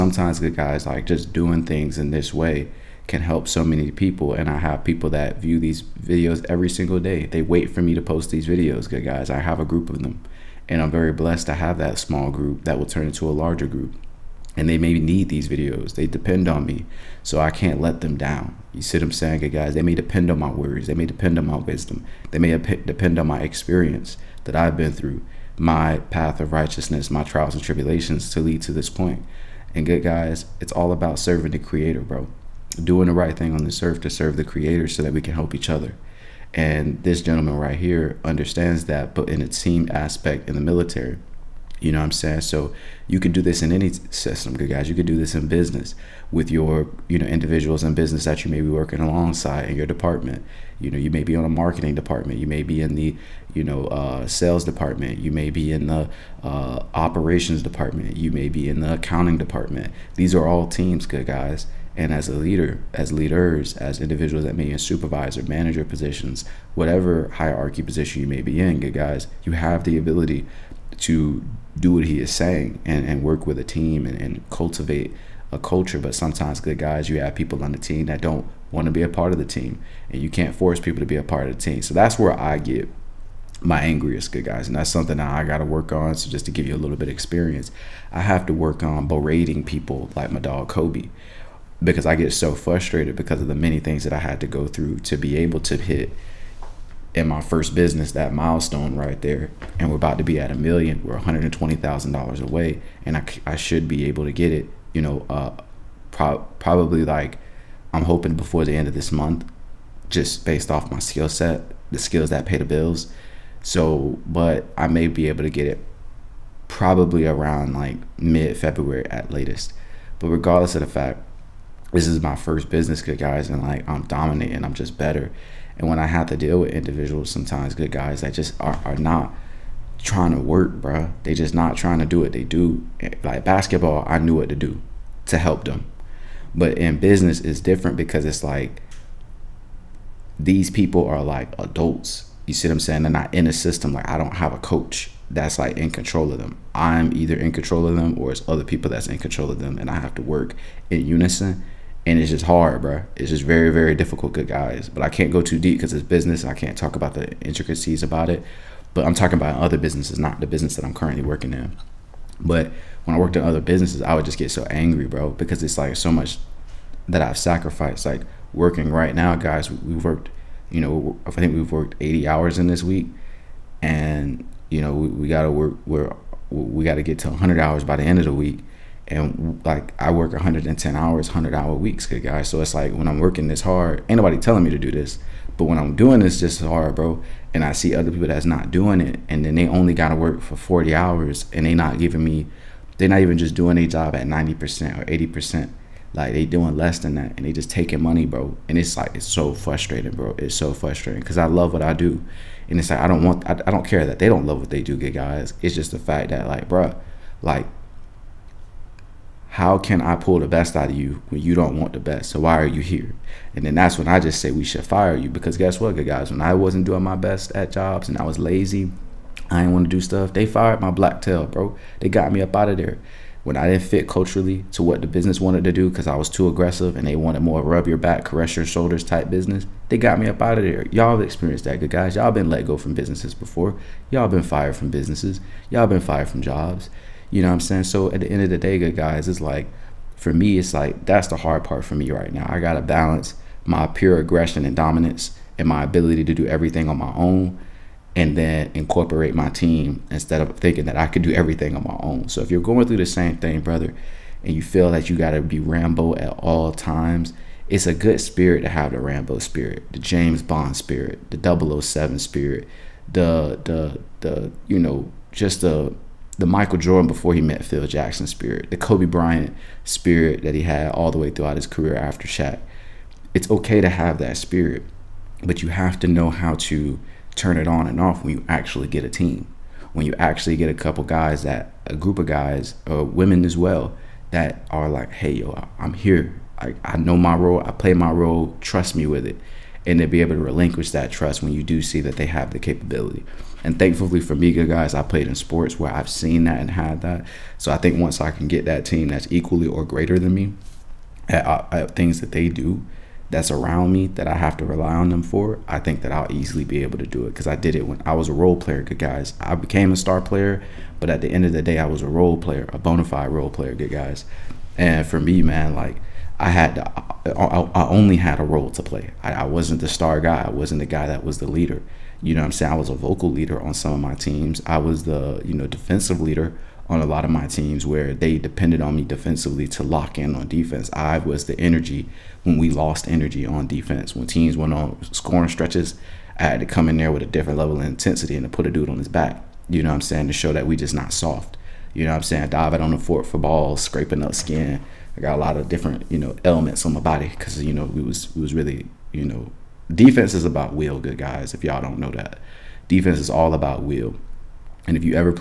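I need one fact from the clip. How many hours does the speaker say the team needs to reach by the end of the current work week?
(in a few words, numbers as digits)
100 hours.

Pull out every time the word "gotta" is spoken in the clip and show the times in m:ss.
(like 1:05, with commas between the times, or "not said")
2:55, 3:09, 4:02.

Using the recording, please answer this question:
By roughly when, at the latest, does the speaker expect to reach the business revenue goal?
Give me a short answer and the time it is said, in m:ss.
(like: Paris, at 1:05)
mid February, at 1:58.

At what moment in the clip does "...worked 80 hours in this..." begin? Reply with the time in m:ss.
2:51.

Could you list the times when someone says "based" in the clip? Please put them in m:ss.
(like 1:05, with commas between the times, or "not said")
1:50.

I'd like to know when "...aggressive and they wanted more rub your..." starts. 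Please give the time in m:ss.
3:46.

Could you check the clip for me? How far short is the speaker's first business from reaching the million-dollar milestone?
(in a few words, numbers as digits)
$120,000.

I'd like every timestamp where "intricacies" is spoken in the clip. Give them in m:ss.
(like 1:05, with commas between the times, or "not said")
2:37.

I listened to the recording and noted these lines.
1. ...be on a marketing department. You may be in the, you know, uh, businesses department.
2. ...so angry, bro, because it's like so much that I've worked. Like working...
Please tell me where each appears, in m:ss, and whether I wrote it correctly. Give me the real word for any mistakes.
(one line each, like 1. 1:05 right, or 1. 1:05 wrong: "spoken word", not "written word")
1. 0:51 wrong: "sales", not "businesses"
2. 2:44 wrong: "sacrificed", not "worked".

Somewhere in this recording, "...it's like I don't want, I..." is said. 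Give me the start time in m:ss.
3:22.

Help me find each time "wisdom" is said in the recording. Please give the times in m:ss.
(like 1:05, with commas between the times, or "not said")
0:21.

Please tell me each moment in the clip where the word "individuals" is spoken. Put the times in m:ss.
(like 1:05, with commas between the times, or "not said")
0:47, 1:04, 2:06.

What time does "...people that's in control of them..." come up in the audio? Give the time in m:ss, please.
2:28.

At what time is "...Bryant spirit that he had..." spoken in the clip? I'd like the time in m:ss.
4:29.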